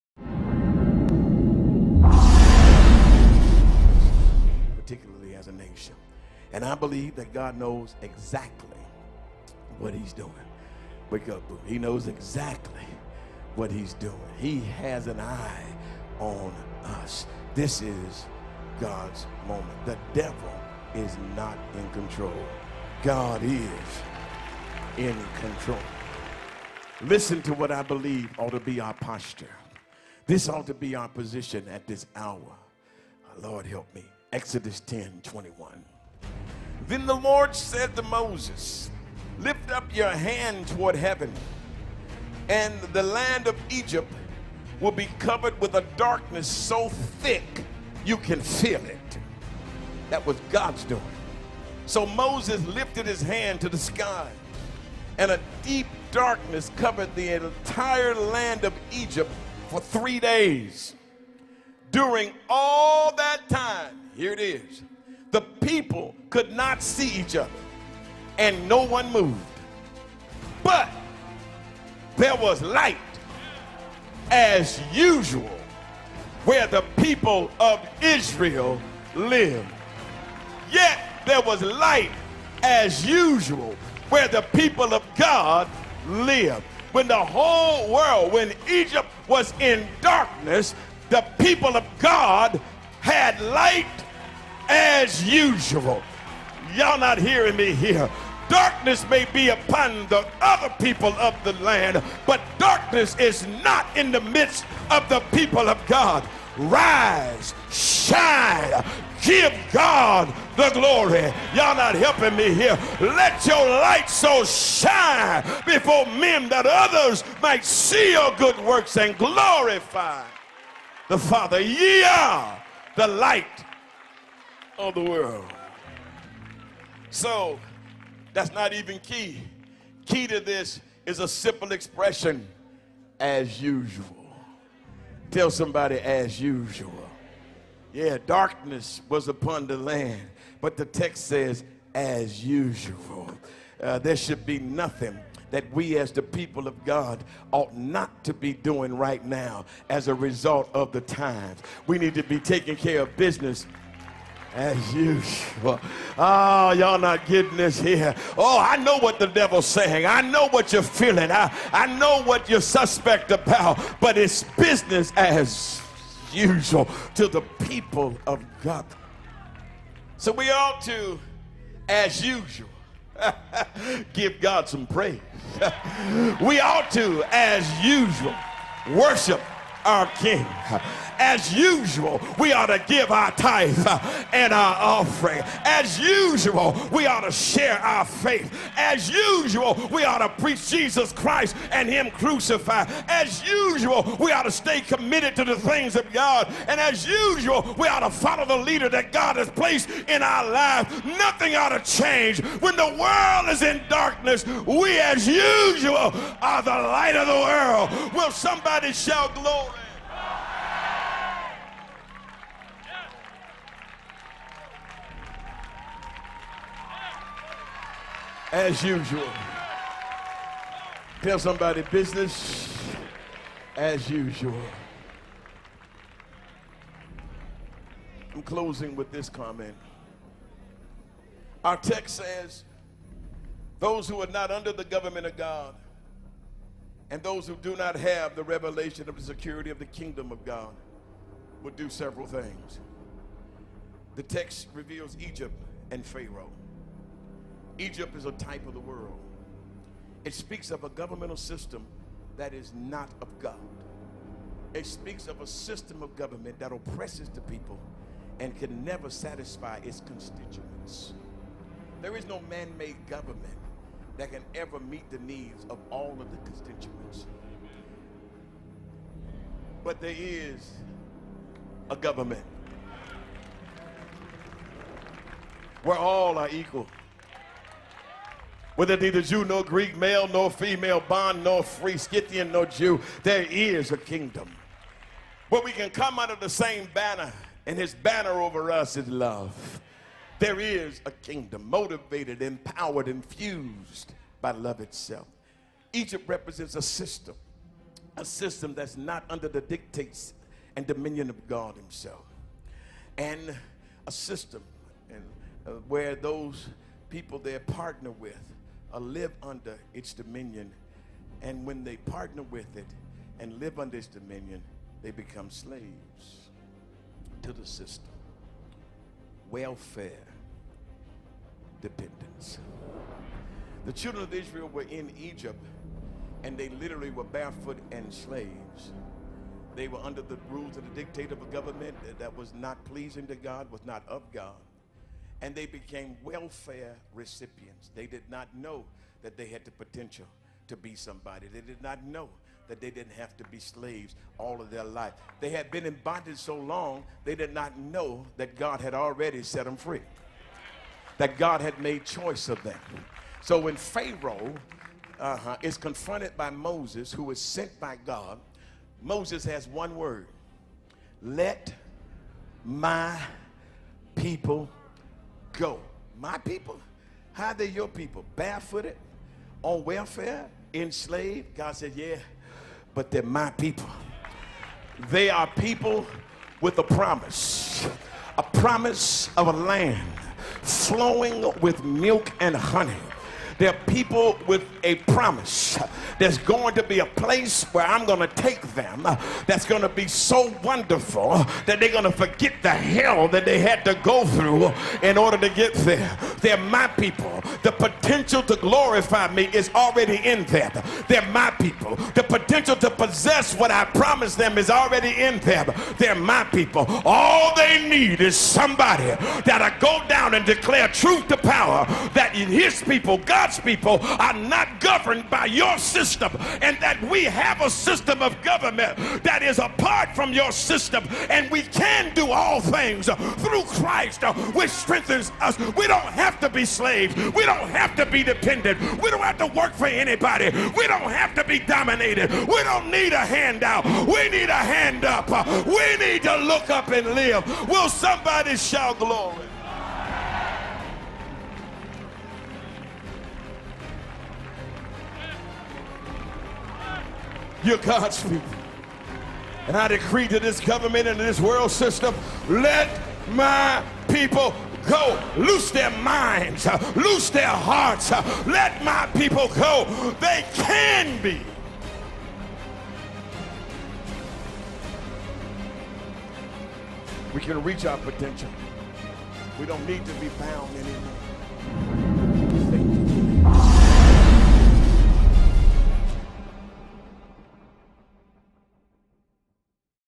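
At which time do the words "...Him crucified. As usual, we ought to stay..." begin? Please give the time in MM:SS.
03:11.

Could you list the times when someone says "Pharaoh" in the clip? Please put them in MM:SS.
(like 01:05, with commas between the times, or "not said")
04:06, 05:53.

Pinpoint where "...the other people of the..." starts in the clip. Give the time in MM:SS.
01:40.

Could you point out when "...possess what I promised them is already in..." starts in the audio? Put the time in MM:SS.
06:42.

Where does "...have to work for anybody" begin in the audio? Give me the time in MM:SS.
07:09.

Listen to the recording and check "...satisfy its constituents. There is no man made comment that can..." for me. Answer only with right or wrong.
wrong.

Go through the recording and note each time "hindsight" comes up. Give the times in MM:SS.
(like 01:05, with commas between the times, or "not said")
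not said.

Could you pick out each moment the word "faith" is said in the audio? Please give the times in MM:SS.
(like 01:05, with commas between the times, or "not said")
03:08.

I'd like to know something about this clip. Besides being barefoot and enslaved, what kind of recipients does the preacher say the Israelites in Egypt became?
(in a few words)
welfare recipients.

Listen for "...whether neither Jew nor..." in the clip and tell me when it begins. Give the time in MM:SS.
04:38.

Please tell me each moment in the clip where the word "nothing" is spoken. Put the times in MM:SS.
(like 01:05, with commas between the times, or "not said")
02:24, 03:21.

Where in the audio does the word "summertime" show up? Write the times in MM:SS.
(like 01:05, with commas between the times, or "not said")
not said.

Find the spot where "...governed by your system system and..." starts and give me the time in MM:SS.
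06:54.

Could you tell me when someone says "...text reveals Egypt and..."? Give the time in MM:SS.
04:04.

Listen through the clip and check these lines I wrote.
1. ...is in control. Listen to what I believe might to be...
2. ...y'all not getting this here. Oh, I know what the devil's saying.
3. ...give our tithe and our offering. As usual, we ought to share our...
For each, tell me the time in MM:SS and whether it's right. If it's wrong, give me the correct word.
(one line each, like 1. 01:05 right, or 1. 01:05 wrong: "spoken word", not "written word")
1. 00:23 wrong: "ought", not "might"
2. 02:36 right
3. 03:02 right.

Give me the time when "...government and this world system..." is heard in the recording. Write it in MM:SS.
07:30.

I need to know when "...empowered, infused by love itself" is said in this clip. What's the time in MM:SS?
04:52.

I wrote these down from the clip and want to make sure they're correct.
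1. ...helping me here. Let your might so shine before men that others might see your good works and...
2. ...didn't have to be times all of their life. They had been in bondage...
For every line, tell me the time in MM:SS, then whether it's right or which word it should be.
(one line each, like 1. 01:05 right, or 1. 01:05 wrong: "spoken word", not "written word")
1. 01:51 wrong: "light", not "might"
2. 05:42 wrong: "slaves", not "times".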